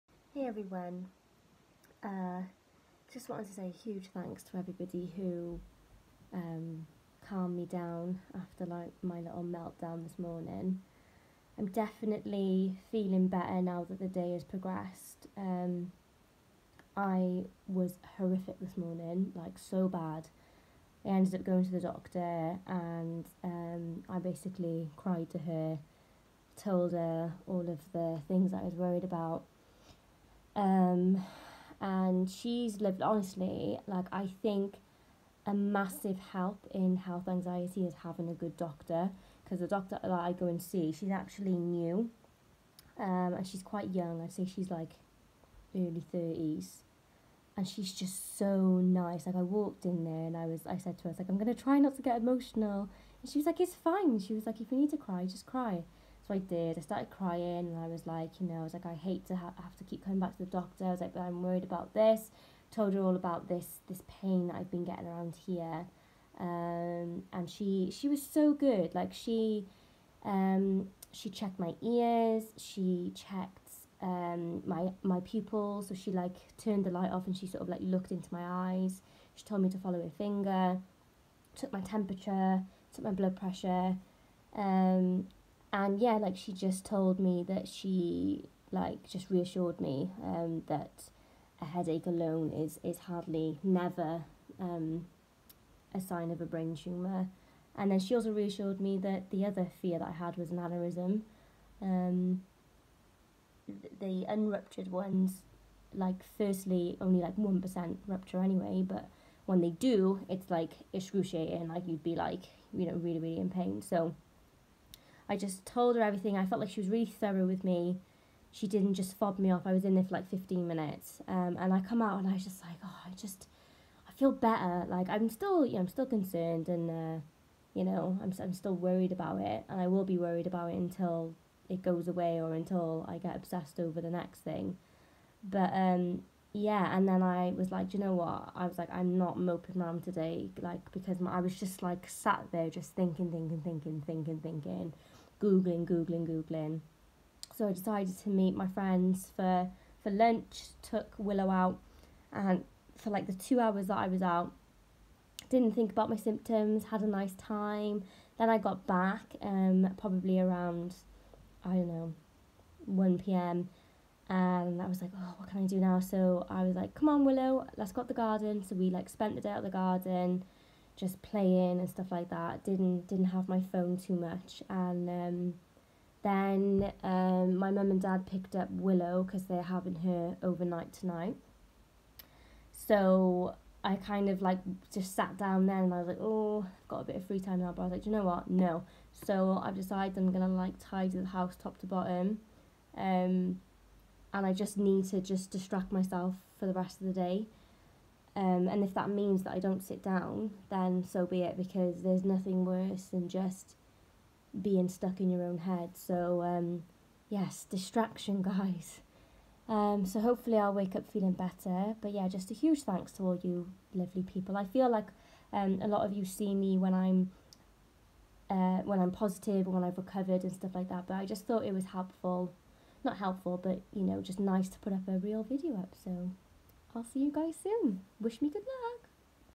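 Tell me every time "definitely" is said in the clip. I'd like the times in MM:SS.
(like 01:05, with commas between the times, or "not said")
00:11.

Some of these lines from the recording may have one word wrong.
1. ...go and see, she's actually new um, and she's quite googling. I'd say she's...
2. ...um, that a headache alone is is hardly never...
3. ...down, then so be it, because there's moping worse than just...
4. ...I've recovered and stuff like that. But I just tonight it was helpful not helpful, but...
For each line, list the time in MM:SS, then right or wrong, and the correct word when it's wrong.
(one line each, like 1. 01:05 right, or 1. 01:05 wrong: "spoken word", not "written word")
1. 00:40 wrong: "young", not "googling"
2. 01:30 right
3. 03:20 wrong: "nothing", not "moping"
4. 03:39 wrong: "thought", not "tonight".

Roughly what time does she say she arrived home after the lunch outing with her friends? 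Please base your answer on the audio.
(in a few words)
1 p.m.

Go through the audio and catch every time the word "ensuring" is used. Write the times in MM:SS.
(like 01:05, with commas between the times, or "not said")
not said.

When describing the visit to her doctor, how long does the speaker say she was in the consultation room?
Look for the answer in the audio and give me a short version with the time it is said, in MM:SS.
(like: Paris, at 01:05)
15 minutes, at 02:00.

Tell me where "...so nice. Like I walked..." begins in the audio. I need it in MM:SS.
00:48.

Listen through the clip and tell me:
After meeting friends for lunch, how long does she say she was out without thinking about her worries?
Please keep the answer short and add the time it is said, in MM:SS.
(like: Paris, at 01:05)
2 hours, at 02:33.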